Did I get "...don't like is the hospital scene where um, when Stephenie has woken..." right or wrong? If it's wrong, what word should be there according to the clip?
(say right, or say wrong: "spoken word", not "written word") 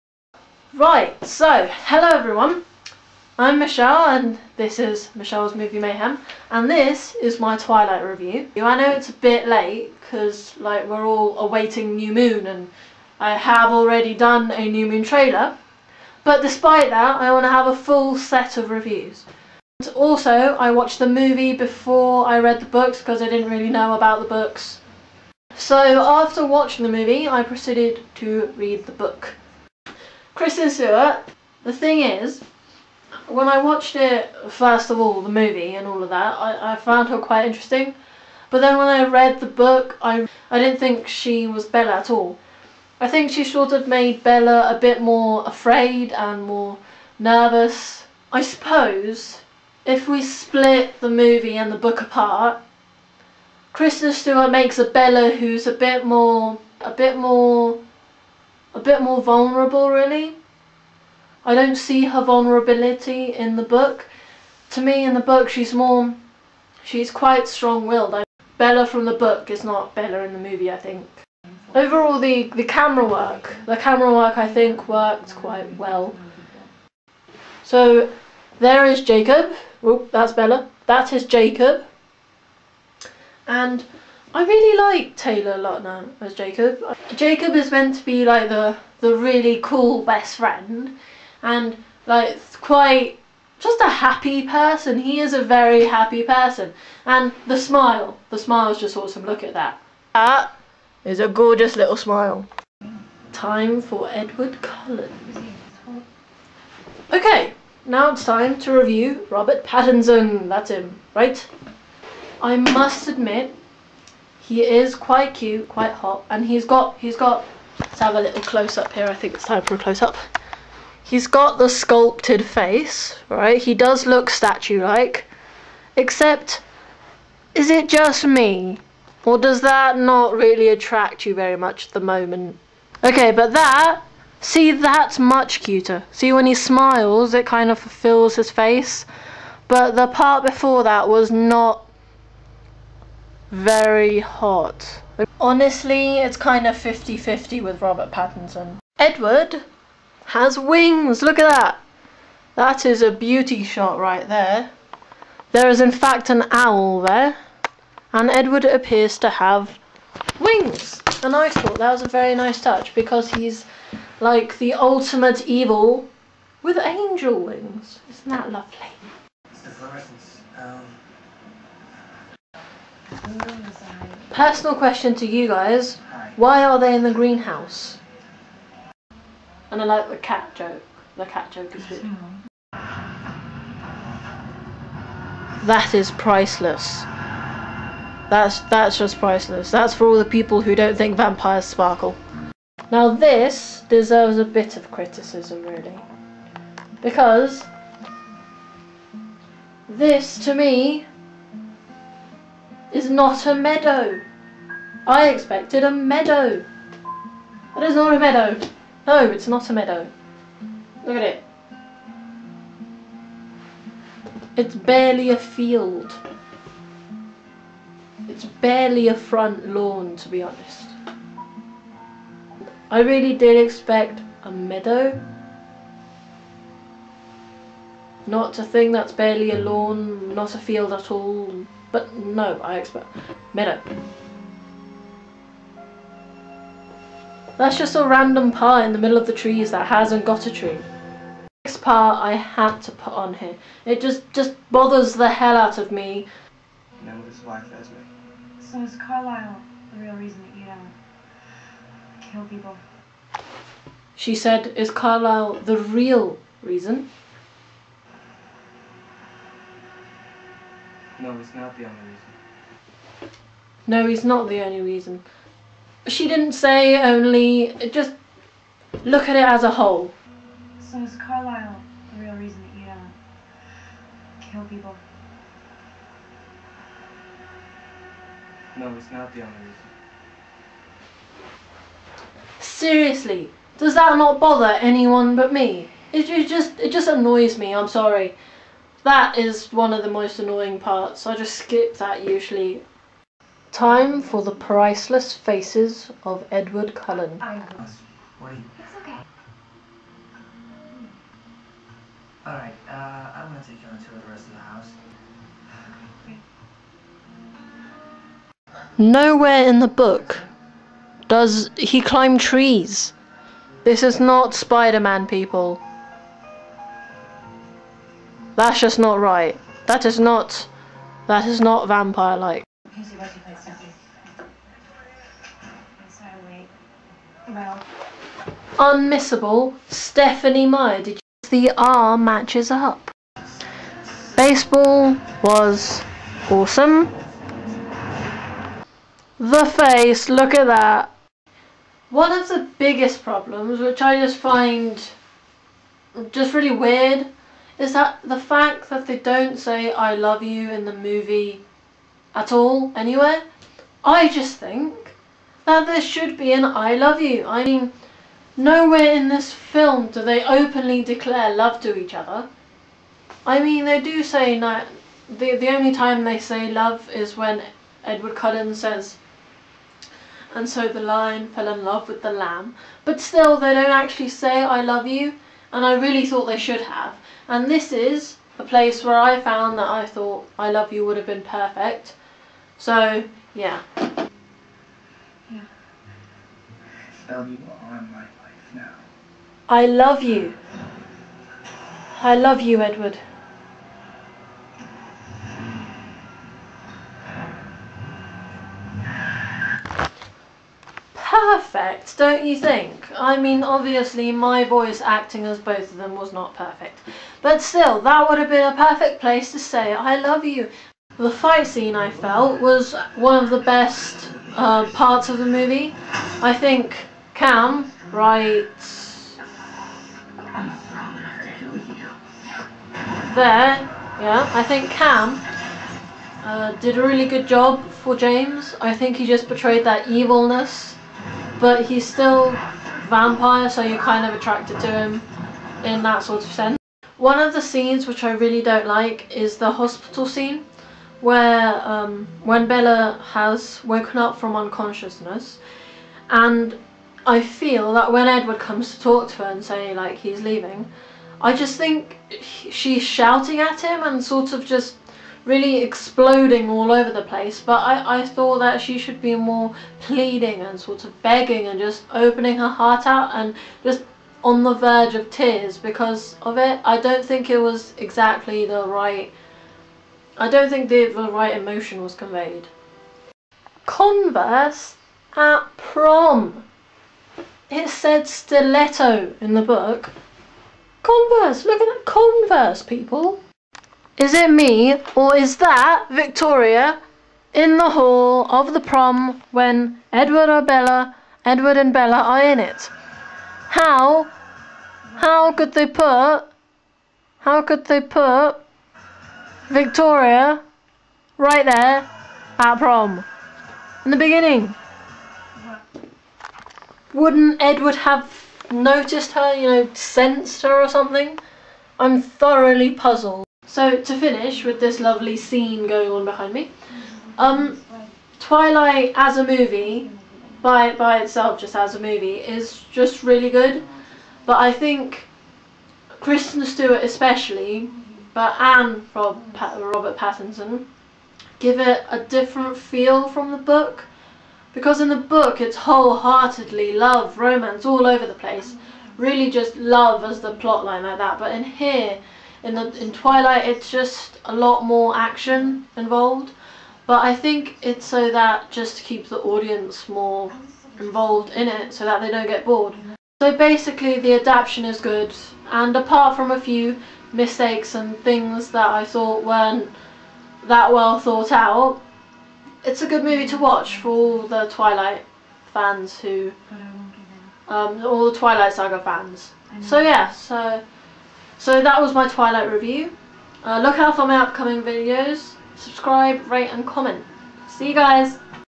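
wrong: "Bella", not "Stephenie".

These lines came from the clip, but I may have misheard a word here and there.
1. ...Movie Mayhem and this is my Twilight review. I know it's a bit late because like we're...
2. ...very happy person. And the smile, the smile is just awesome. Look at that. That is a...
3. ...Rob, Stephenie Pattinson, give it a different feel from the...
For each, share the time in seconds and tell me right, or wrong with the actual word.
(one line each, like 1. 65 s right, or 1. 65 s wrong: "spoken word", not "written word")
1. 5 s right
2. 95 s right
3. 529 s wrong: "Robert", not "Stephenie".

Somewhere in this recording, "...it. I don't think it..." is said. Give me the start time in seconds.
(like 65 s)
466 s.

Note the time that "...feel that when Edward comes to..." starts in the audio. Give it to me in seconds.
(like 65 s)
447 s.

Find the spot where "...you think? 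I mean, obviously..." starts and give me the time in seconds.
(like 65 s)
402 s.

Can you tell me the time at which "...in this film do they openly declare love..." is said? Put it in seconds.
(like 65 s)
359 s.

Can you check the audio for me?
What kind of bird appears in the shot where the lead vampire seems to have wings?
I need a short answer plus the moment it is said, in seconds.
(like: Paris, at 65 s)
Owl, at 156 s.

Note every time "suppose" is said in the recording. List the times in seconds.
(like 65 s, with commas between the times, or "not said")
48 s.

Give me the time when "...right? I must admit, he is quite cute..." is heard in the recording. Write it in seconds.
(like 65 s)
111 s.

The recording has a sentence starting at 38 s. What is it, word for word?
But then when I read the book, I, I didn't think she was Bella at all.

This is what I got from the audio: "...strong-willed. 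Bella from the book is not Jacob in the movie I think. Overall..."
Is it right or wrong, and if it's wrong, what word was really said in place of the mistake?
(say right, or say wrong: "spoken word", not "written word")
wrong: "Bella", not "Jacob".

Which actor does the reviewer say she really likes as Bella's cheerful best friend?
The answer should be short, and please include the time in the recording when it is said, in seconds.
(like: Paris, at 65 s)
Taylor Lautner, at 85 s.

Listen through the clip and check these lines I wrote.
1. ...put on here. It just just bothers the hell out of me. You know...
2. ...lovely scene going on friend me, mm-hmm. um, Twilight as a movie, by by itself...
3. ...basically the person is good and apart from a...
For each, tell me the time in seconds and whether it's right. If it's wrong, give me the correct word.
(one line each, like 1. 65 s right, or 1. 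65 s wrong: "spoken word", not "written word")
1. 242 s right
2. 514 s wrong: "behind", not "friend"
3. 553 s wrong: "adaptation", not "person".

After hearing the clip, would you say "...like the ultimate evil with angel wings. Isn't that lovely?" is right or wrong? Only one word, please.
right.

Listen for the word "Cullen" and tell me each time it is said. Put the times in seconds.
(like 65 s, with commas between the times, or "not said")
104 s, 296 s, 368 s.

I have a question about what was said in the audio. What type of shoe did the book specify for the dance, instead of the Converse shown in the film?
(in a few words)
Stiletto.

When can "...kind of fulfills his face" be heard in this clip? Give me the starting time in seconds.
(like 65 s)
137 s.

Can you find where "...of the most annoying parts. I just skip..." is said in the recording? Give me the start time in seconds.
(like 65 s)
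289 s.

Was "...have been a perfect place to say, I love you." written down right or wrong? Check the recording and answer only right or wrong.
right.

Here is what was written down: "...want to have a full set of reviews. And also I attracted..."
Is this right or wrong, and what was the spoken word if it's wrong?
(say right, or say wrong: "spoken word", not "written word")
wrong: "watched", not "attracted".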